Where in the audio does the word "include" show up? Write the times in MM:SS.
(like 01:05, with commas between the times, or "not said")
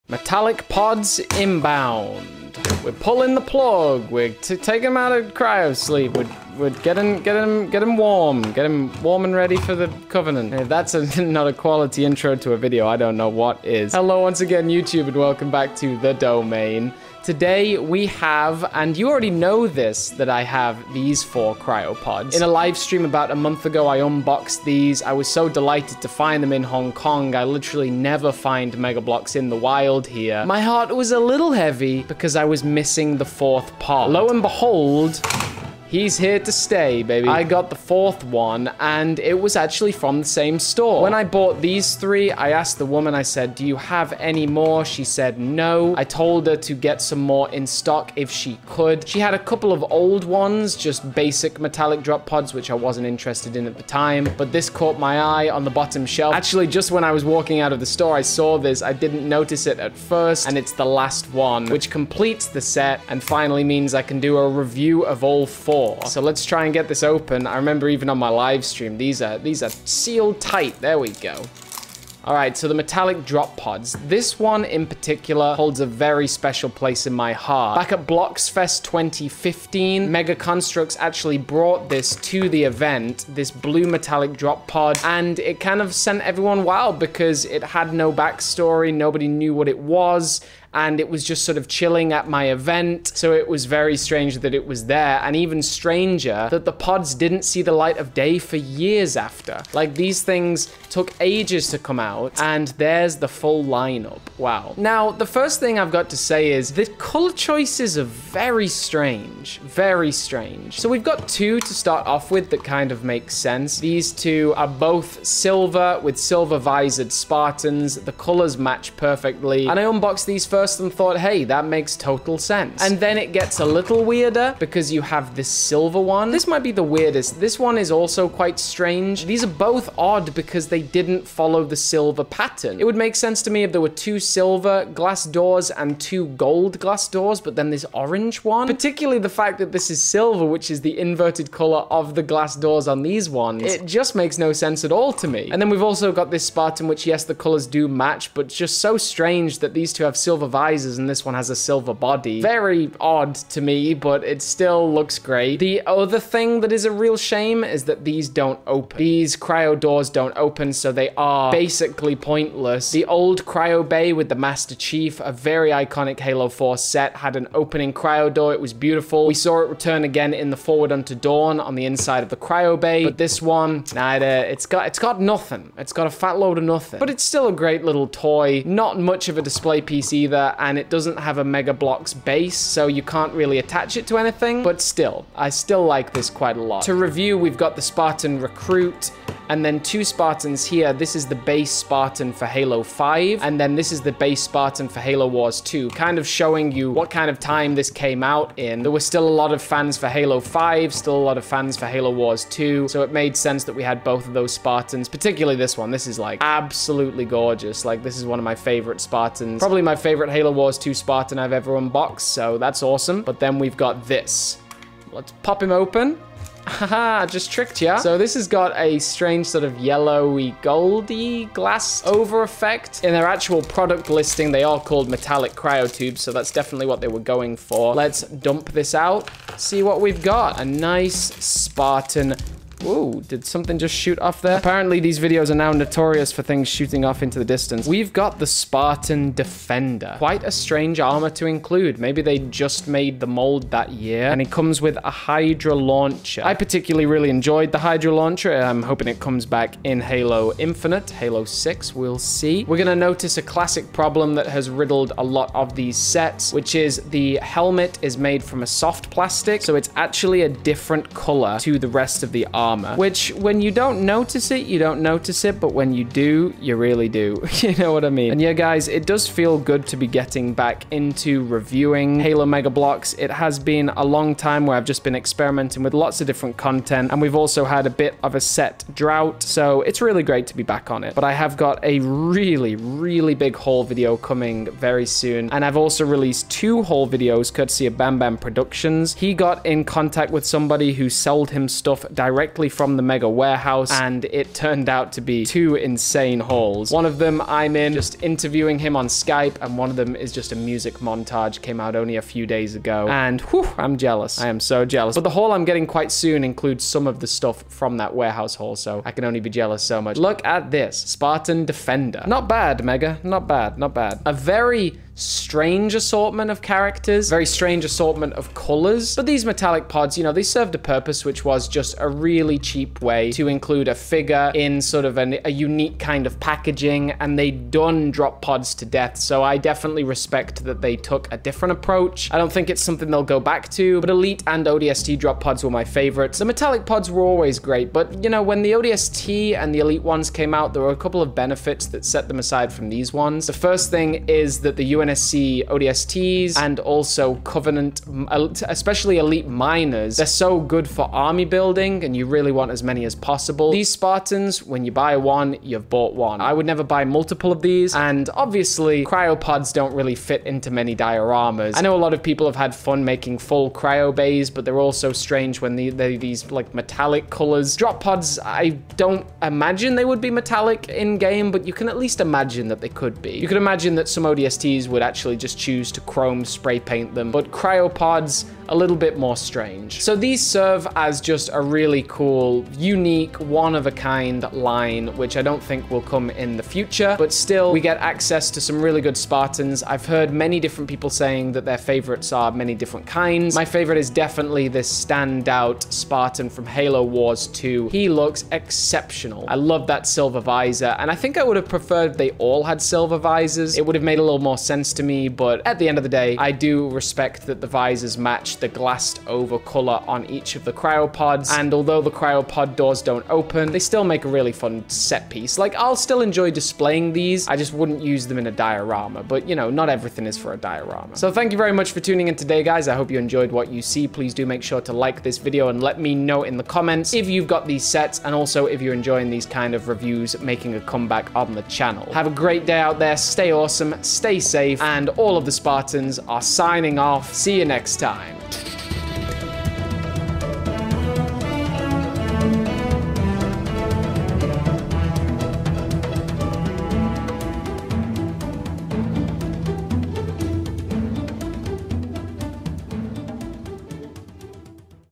04:01, 05:06, 05:23.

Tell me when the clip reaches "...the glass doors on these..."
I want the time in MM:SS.
02:22.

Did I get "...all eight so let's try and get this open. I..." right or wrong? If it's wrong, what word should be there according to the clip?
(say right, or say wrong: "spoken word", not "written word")
wrong: "four", not "eight".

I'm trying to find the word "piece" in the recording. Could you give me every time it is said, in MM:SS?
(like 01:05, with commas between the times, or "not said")
02:59, 06:55.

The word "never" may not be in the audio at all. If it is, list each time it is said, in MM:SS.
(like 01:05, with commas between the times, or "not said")
00:27, 05:56.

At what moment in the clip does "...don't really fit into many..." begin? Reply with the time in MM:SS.
05:59.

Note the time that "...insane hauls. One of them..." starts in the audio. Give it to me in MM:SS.
04:55.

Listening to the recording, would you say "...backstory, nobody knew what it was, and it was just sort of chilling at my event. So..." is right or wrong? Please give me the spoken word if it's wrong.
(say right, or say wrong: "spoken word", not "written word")
right.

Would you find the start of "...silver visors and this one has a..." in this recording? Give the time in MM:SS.
02:30.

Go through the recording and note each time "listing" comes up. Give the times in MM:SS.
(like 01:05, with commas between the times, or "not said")
03:44.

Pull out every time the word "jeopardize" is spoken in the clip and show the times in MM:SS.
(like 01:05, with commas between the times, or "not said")
not said.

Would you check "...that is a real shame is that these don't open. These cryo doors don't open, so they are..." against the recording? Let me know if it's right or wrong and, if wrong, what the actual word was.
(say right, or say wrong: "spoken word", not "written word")
right.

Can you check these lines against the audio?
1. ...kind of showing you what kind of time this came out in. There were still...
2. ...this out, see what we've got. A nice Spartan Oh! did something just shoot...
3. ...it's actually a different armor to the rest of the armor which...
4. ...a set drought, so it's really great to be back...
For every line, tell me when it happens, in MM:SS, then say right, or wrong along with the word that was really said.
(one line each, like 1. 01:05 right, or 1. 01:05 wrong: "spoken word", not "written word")
1. 03:15 right
2. 03:48 right
3. 04:19 wrong: "color", not "armor"
4. 04:38 right.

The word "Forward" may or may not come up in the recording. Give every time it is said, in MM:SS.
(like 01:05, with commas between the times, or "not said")
02:50.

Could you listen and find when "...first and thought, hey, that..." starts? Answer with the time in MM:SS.
02:00.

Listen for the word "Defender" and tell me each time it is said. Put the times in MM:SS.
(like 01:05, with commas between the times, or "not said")
03:59, 05:11.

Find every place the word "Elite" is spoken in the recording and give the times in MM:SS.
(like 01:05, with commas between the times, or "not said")
05:34, 05:39, 05:49.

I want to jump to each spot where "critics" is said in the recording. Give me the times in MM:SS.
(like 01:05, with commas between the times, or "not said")
not said.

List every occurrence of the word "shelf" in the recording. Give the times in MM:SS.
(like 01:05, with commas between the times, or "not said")
00:56.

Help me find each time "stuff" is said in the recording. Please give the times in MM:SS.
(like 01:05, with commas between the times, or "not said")
04:51, 05:07.